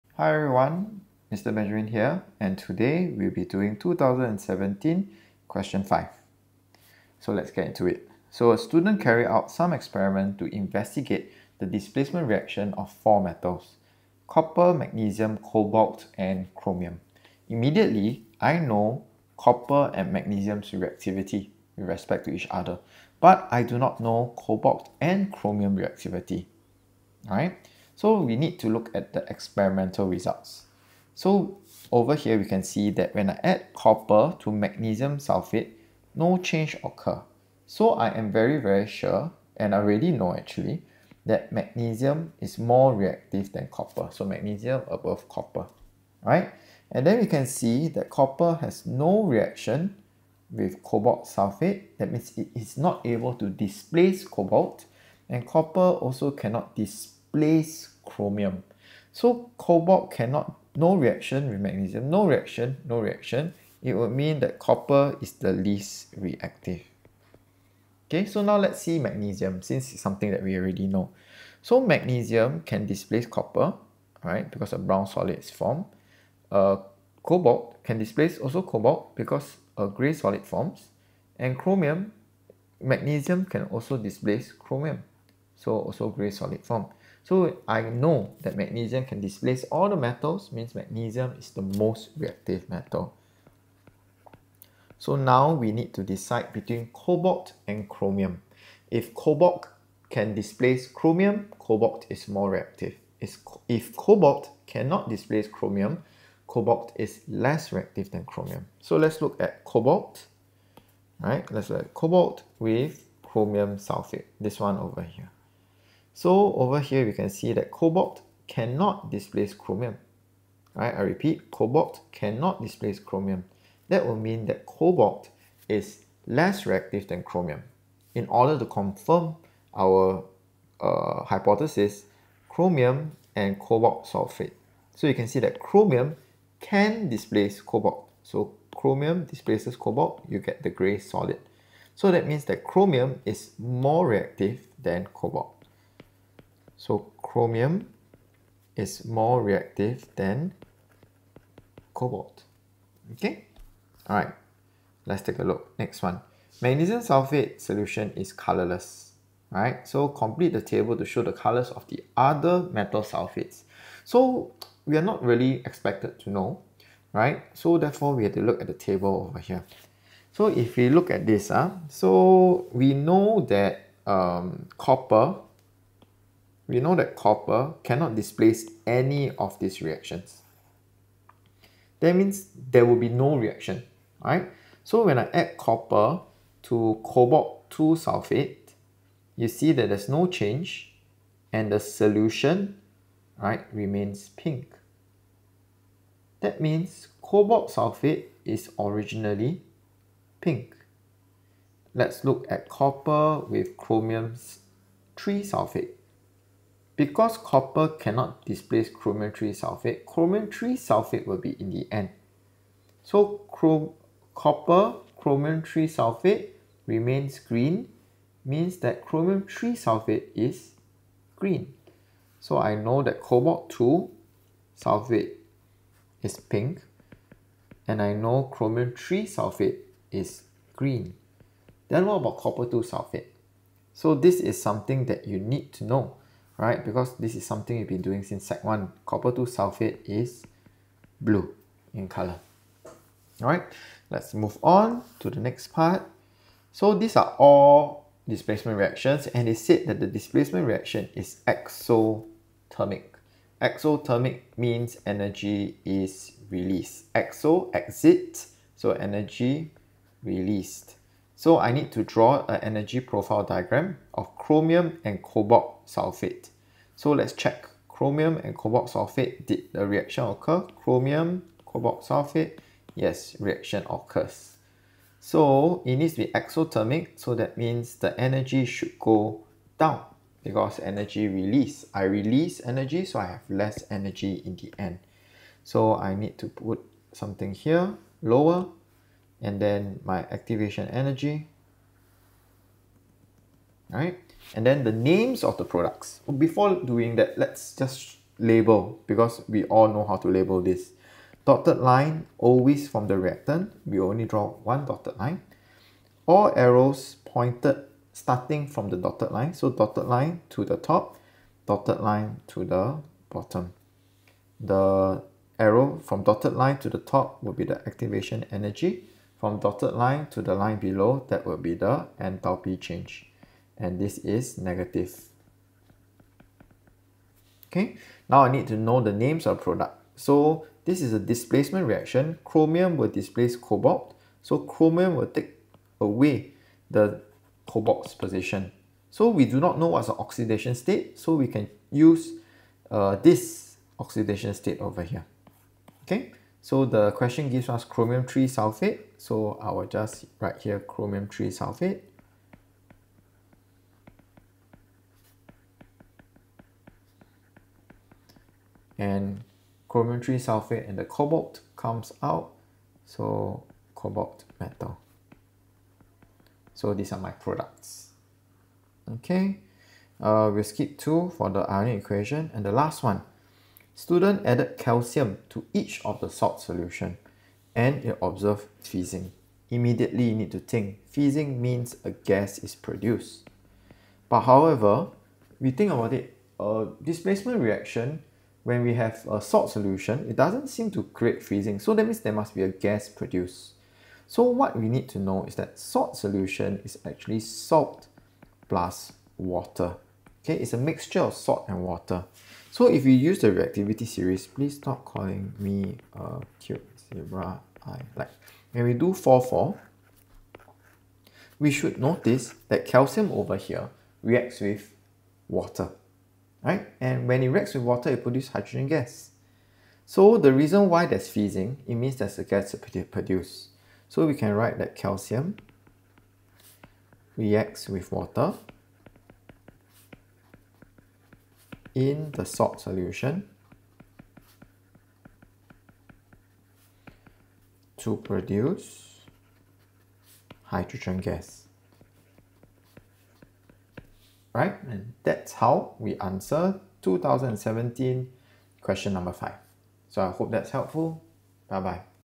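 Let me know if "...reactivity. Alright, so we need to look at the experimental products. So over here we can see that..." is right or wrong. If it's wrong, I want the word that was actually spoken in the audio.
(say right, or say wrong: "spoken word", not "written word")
wrong: "results", not "products".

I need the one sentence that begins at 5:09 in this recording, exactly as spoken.
So dotted line to the top, dotted line to the bottom.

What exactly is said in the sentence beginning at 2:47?
So therefore we have to look at the table over here.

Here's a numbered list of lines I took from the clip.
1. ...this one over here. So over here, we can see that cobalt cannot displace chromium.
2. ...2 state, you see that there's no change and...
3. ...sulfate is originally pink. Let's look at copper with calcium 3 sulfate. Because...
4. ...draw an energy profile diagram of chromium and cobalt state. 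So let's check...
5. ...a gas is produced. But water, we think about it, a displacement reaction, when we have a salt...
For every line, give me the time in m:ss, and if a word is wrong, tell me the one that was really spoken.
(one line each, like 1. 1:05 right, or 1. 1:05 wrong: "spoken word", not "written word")
1. 1:54 right
2. 3:07 wrong: "sulfate", not "state"
3. 3:17 wrong: "chromium", not "calcium"
4. 4:22 wrong: "sulfate", not "state"
5. 6:22 wrong: "however", not "water".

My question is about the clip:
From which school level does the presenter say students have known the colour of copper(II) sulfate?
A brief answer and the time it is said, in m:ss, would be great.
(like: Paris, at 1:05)
Sec 1, at 3:58.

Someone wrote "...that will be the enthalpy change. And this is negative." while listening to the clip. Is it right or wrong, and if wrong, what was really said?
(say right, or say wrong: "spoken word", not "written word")
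right.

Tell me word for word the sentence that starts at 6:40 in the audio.
Okay, it's a mixture of salt and water.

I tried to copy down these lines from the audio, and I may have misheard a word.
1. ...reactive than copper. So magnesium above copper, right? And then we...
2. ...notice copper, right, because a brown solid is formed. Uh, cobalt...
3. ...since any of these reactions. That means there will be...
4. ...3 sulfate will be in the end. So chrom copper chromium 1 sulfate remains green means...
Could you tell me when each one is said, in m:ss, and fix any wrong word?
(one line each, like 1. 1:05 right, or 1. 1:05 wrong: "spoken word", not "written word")
1. 0:42 right
2. 1:12 wrong: "displace", not "notice"
3. 2:58 wrong: "displace", not "since"
4. 3:30 wrong: "3", not "1".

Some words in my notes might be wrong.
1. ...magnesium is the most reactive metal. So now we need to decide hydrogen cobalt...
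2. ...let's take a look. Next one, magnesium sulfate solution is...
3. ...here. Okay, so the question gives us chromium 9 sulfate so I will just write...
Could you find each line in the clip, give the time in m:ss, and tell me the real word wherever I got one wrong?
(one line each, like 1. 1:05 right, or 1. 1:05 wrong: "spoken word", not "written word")
1. 1:30 wrong: "between", not "hydrogen"
2. 2:35 right
3. 5:45 wrong: "3", not "9".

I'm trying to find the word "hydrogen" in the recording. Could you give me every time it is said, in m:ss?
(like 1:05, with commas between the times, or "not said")
6:58, 7:20.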